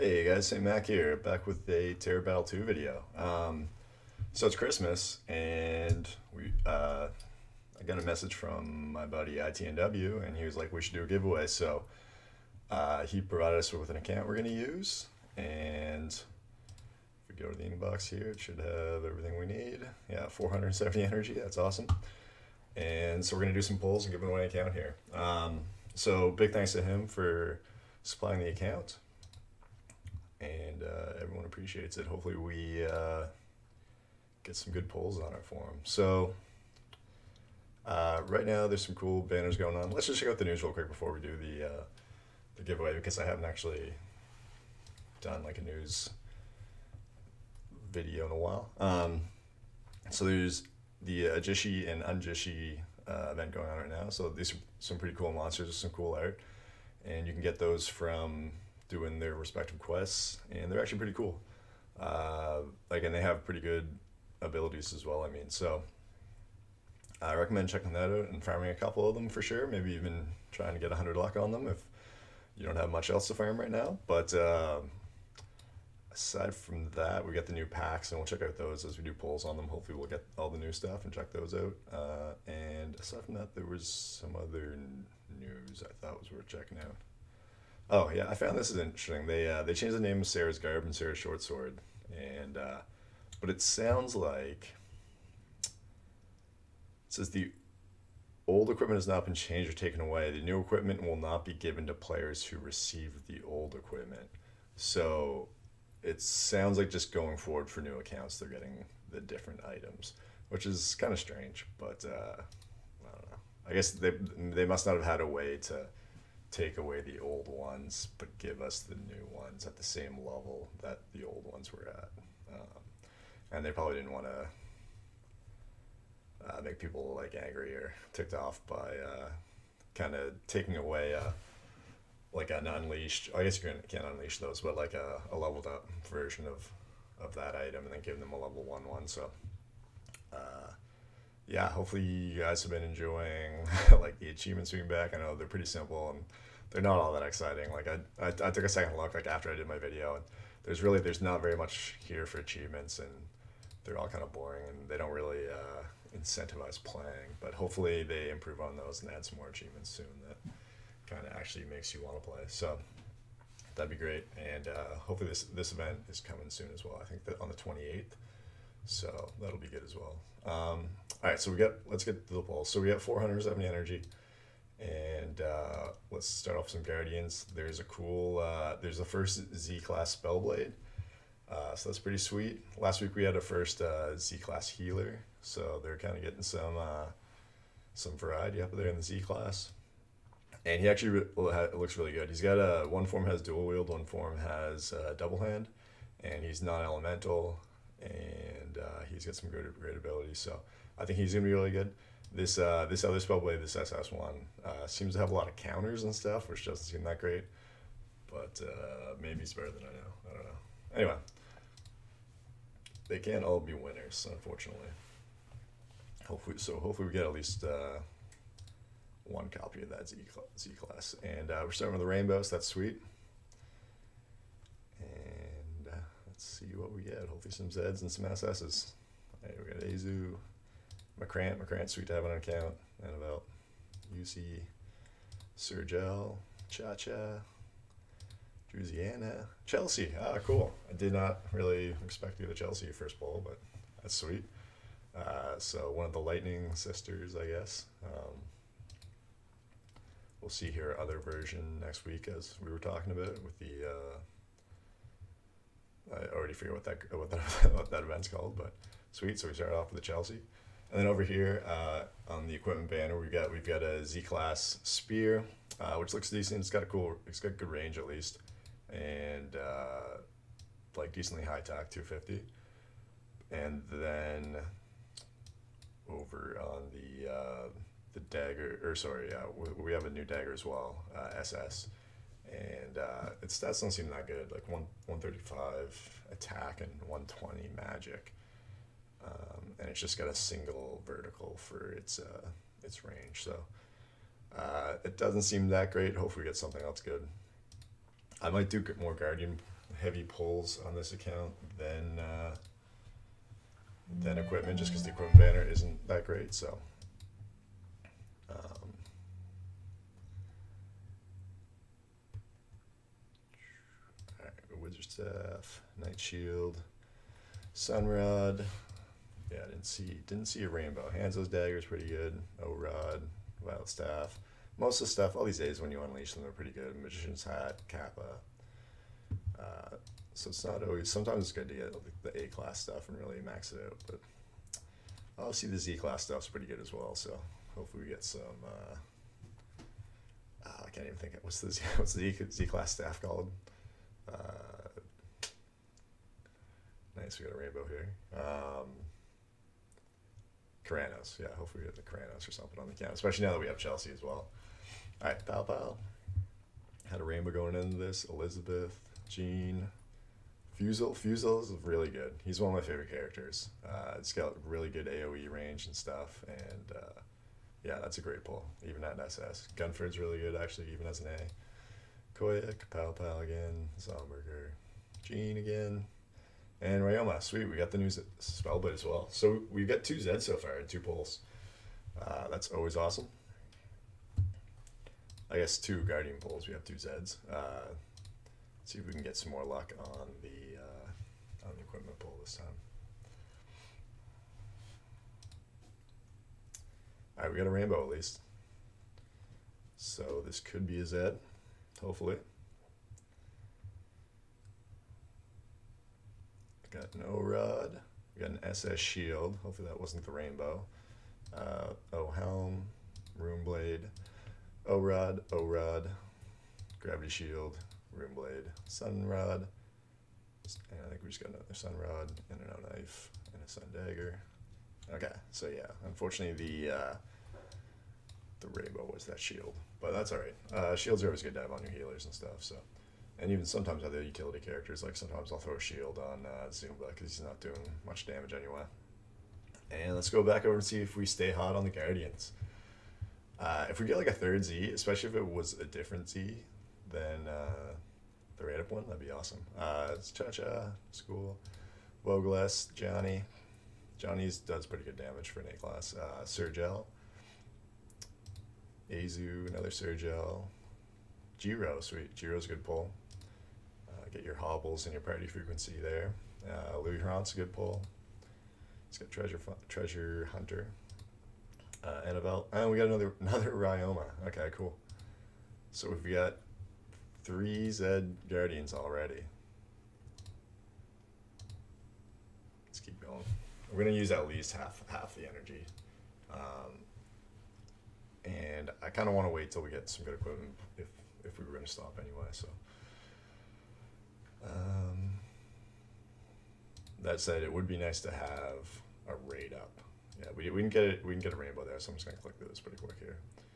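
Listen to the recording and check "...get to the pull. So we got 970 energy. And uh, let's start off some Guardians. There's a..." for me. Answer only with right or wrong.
wrong.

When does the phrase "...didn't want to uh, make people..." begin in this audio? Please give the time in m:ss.
2:03.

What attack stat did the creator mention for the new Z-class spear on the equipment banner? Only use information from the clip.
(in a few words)
250.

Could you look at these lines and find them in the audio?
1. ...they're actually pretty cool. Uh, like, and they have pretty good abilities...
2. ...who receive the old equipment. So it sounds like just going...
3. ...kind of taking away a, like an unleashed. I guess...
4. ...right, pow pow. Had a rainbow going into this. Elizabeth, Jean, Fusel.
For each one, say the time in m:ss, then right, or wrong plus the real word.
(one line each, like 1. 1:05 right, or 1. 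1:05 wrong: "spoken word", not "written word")
1. 1:00 right
2. 1:42 right
3. 2:09 right
4. 5:55 right.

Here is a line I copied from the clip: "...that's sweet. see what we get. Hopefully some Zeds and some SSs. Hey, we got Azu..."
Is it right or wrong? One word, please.
right.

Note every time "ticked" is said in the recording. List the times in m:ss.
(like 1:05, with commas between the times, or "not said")
2:08.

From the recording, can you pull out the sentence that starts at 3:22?
This uh, this other Spellblade, this SS1, uh, seems to have a lot of counters and stuff, which doesn't seem that great.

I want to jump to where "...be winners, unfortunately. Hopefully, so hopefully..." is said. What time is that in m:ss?
3:33.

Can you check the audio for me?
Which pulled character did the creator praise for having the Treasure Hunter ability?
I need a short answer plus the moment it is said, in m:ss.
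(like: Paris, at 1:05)
Louis Hrant, at 7:46.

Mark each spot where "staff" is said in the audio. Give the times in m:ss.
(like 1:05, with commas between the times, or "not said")
5:15, 5:23, 5:42.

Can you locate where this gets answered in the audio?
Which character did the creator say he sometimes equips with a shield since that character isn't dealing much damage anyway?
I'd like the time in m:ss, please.
7:16.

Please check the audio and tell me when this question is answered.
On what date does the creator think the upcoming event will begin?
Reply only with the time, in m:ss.
2:47.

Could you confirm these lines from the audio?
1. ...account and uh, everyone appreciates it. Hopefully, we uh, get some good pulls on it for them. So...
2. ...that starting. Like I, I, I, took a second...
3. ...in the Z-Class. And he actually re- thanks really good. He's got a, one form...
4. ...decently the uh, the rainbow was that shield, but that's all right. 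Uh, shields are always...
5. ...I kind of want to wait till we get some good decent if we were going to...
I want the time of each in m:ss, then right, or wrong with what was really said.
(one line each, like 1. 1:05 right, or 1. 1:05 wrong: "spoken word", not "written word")
1. 0:28 right
2. 2:27 wrong: "exciting", not "starting"
3. 3:08 wrong: "looks", not "thanks"
4. 7:06 wrong: "unfortunately", not "decently"
5. 8:09 wrong: "equipment", not "decent".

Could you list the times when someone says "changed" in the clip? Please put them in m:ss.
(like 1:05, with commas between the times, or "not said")
1:29, 1:39.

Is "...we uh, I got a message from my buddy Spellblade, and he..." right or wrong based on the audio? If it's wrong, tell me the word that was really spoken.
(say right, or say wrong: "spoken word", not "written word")
wrong: "ITNW", not "Spellblade".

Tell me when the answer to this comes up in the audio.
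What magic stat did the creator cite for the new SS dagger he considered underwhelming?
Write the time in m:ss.
4:47.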